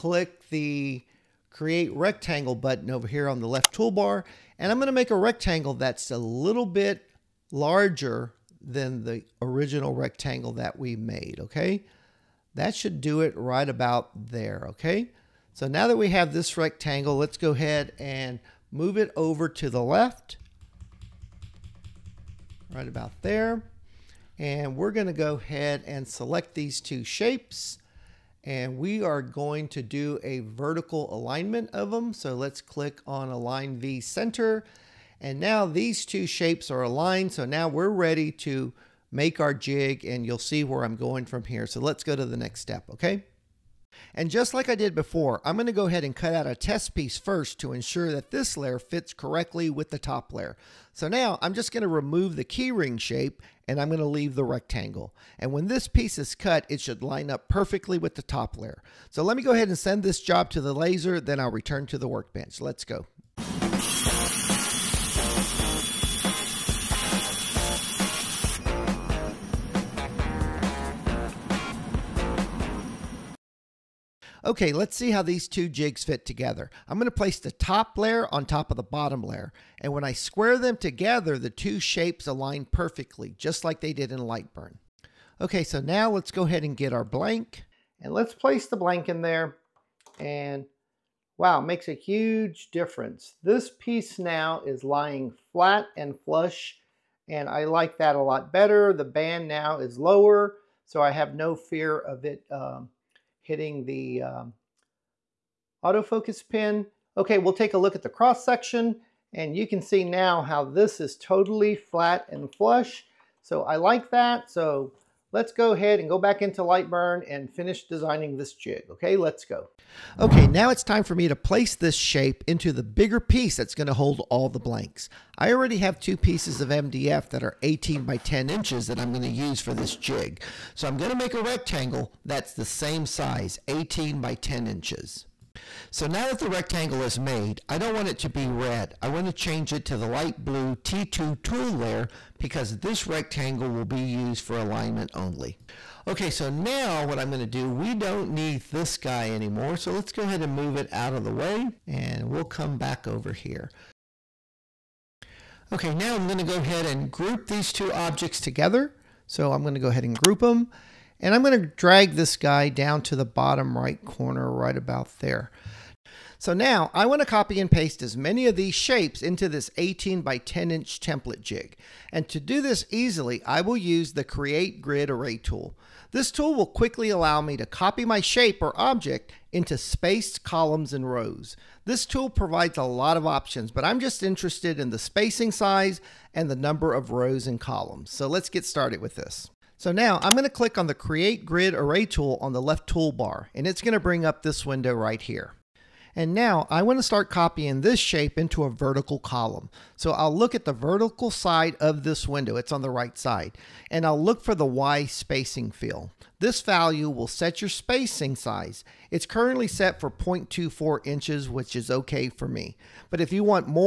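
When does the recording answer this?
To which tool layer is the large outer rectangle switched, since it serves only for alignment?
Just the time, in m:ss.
2:20.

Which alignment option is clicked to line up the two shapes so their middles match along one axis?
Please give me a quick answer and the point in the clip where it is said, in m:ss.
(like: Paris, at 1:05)
Align V Center, at 0:33.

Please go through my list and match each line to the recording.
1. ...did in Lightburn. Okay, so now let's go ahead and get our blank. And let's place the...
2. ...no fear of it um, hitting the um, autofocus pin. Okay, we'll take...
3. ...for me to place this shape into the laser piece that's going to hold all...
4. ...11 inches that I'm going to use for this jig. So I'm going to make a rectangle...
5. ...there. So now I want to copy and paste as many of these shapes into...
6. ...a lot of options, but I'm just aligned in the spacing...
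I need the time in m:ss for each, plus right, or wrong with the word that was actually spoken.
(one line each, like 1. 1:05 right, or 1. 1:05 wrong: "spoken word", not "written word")
1. 1:23 right
2. 1:41 right
3. 2:01 wrong: "bigger", not "laser"
4. 2:08 wrong: "10", not "11"
5. 2:45 right
6. 3:02 wrong: "interested", not "aligned".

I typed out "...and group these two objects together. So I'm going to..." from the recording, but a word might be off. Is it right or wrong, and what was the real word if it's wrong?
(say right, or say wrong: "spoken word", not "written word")
right.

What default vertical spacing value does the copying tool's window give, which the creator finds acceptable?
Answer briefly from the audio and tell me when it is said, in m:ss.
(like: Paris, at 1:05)
0.24 inches, at 3:30.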